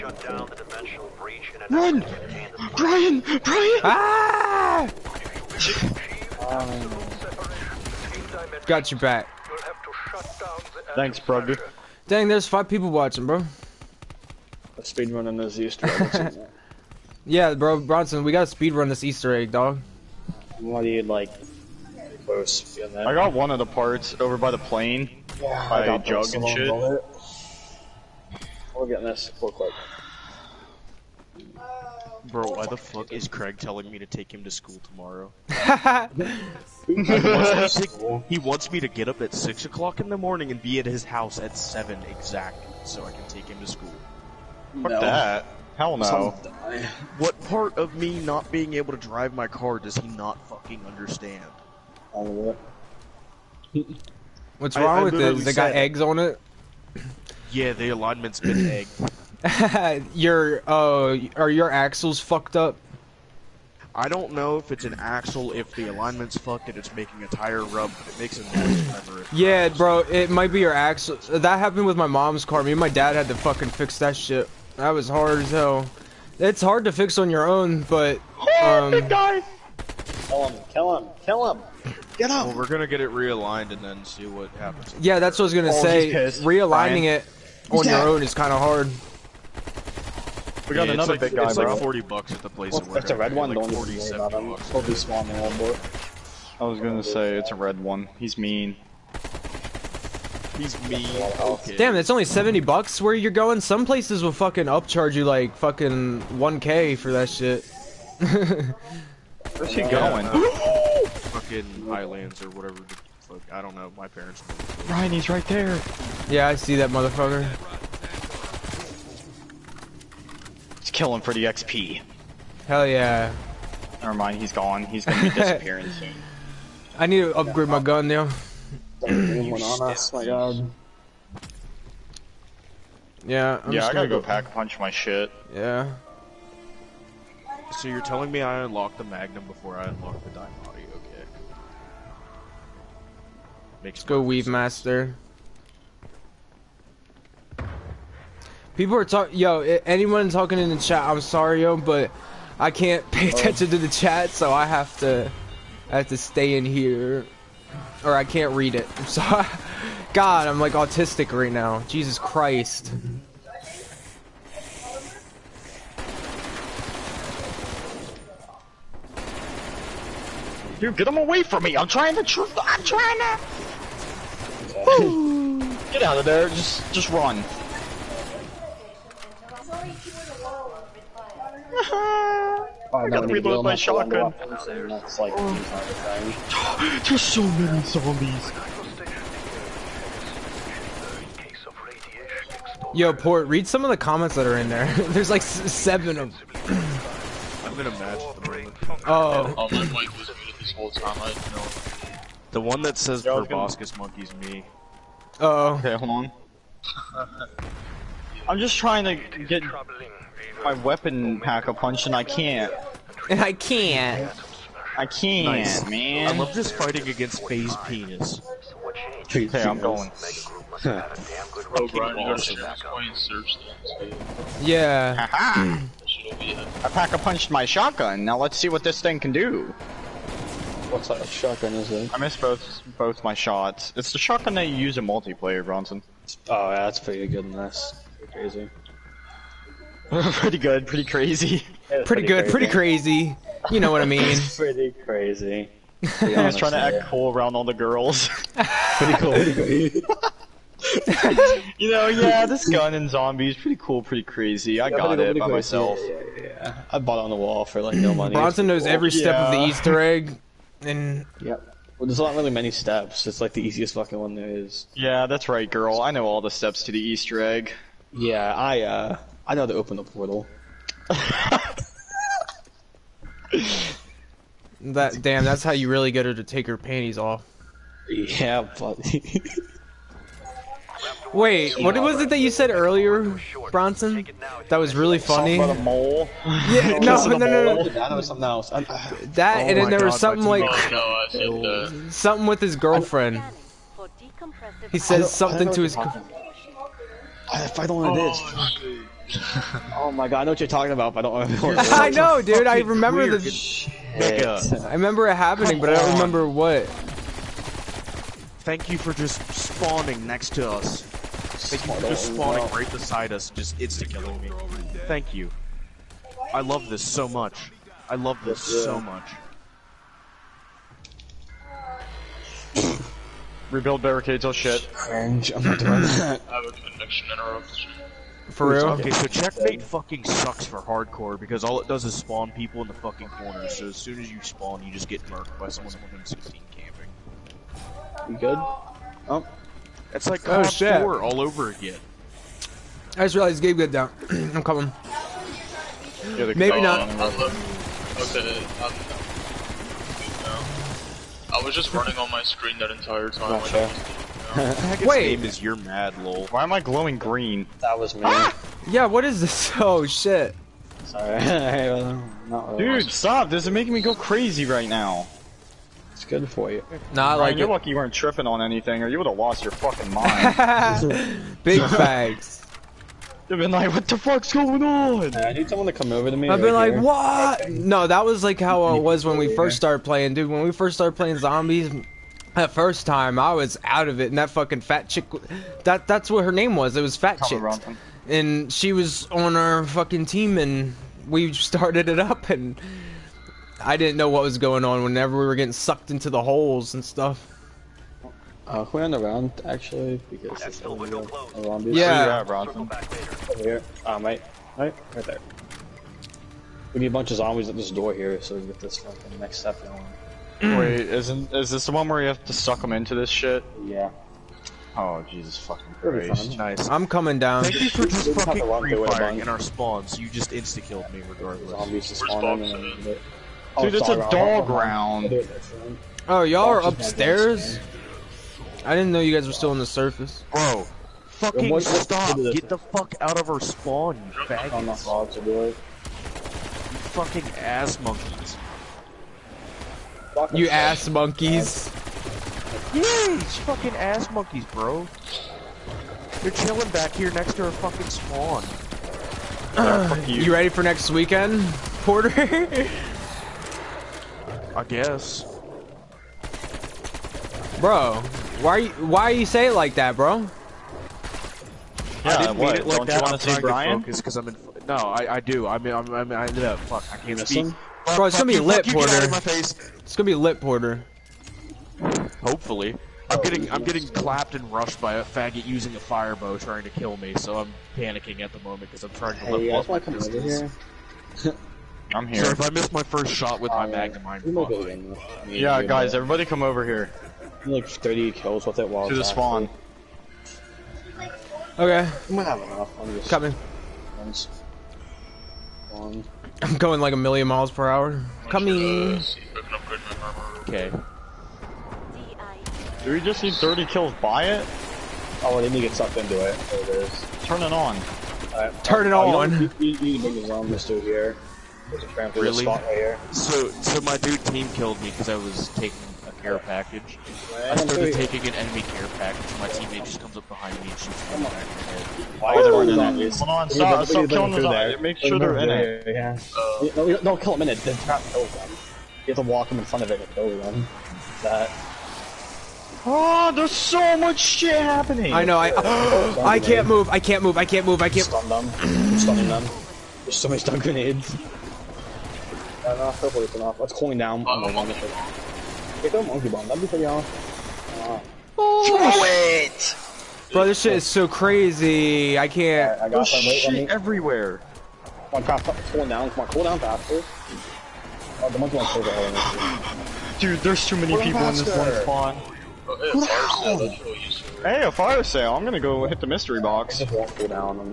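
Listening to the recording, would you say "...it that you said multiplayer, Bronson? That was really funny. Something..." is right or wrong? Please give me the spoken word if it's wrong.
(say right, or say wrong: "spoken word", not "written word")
wrong: "earlier", not "multiplayer".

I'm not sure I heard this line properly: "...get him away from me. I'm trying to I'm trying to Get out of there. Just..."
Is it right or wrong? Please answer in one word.
right.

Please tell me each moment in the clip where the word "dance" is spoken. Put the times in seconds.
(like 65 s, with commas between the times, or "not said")
not said.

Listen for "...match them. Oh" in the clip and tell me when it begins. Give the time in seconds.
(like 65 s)
197 s.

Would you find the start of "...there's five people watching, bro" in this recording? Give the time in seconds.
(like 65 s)
12 s.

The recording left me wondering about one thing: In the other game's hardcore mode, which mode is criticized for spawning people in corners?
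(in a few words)
checkmate.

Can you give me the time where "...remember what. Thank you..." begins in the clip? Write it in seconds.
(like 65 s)
306 s.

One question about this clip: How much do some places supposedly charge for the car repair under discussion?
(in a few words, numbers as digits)
1k.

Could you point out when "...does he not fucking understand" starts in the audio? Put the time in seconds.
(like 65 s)
49 s.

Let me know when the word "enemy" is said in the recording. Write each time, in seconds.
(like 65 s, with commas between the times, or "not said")
518 s.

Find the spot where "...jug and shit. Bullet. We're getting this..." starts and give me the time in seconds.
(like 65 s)
26 s.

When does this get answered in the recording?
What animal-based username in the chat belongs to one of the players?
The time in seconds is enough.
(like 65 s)
203 s.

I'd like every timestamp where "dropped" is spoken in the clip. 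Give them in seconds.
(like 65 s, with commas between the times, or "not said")
not said.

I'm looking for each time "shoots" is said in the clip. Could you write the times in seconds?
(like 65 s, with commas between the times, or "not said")
520 s.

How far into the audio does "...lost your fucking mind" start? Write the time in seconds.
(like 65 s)
369 s.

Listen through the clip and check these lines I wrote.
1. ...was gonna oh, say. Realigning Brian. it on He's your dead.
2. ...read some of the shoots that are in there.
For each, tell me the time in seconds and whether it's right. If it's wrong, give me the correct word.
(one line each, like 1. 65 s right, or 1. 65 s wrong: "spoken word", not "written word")
1. 85 s right
2. 193 s wrong: "comments", not "shoots".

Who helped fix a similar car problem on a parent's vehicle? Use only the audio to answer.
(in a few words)
my dad.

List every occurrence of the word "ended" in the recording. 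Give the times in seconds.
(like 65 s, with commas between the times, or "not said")
466 s.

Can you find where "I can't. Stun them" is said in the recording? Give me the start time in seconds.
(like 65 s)
538 s.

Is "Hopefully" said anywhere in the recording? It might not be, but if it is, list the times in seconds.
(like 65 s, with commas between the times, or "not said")
472 s, 543 s.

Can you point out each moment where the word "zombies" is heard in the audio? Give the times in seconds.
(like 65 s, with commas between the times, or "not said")
187 s, 253 s, 381 s, 407 s, 421 s.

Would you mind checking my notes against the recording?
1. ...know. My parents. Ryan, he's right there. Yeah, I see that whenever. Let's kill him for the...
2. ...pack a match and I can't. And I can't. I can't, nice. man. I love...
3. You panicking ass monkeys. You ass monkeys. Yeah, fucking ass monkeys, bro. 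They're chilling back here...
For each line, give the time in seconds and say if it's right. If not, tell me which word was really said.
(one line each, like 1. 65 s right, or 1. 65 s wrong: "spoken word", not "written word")
1. 113 s wrong: "motherfucker", not "whenever"
2. 211 s wrong: "punch", not "match"
3. 435 s wrong: "fucking", not "panicking".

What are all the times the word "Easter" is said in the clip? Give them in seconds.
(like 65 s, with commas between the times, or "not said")
19 s, 259 s, 267 s.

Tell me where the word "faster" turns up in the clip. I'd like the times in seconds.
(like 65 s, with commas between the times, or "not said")
556 s, 561 s.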